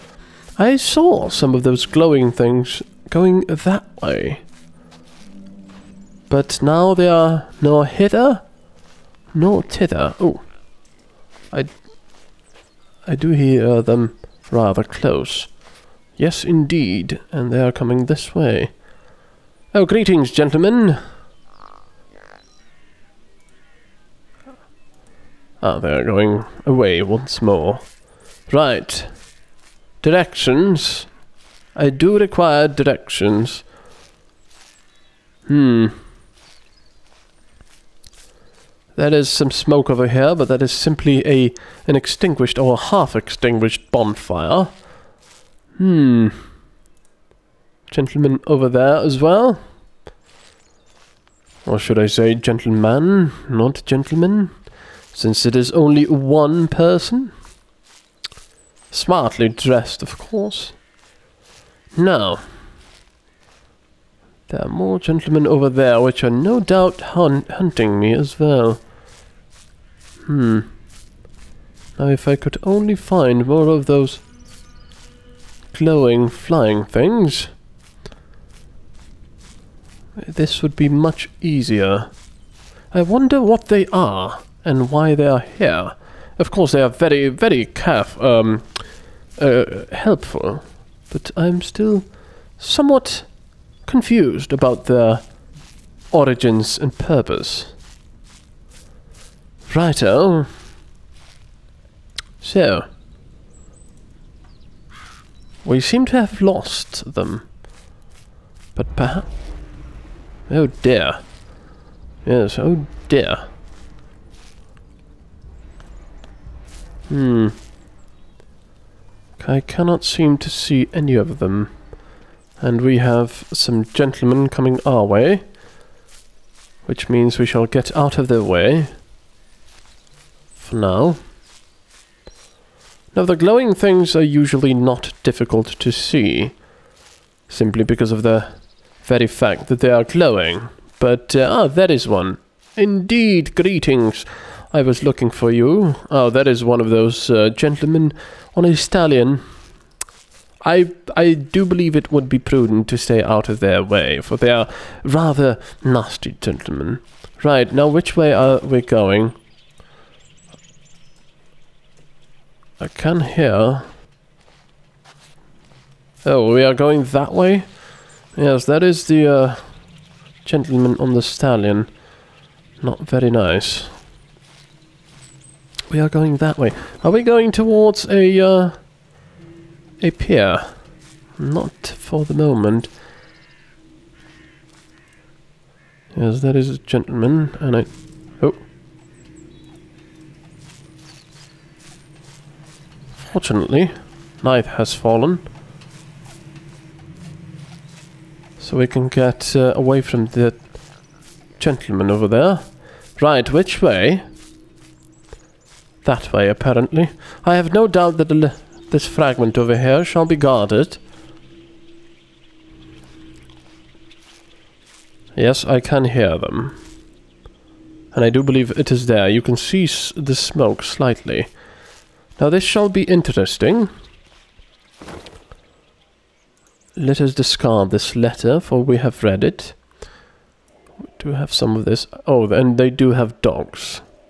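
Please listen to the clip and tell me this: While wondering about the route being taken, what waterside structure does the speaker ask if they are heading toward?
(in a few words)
A pier.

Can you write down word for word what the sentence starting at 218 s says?
And I do believe it is there.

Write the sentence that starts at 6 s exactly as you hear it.
But now they are nor hither, nor thither.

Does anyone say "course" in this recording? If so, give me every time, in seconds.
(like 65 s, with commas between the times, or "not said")
60 s, 86 s.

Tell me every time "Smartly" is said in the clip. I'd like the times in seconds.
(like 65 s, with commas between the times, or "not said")
58 s.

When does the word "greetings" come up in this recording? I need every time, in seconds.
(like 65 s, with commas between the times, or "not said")
19 s, 143 s.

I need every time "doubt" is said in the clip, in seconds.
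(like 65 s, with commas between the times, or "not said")
66 s, 207 s.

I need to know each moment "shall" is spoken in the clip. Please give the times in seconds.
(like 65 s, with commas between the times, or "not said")
127 s, 210 s, 222 s.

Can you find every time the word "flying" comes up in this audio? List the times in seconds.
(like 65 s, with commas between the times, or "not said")
76 s.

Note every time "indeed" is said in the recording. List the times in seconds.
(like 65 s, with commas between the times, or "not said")
16 s, 142 s.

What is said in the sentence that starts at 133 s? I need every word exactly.
Now the glowing things are usually not difficult to see.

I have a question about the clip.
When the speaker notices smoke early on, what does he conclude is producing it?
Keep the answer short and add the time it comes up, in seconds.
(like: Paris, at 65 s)
Half-extinguished bonfire, at 42 s.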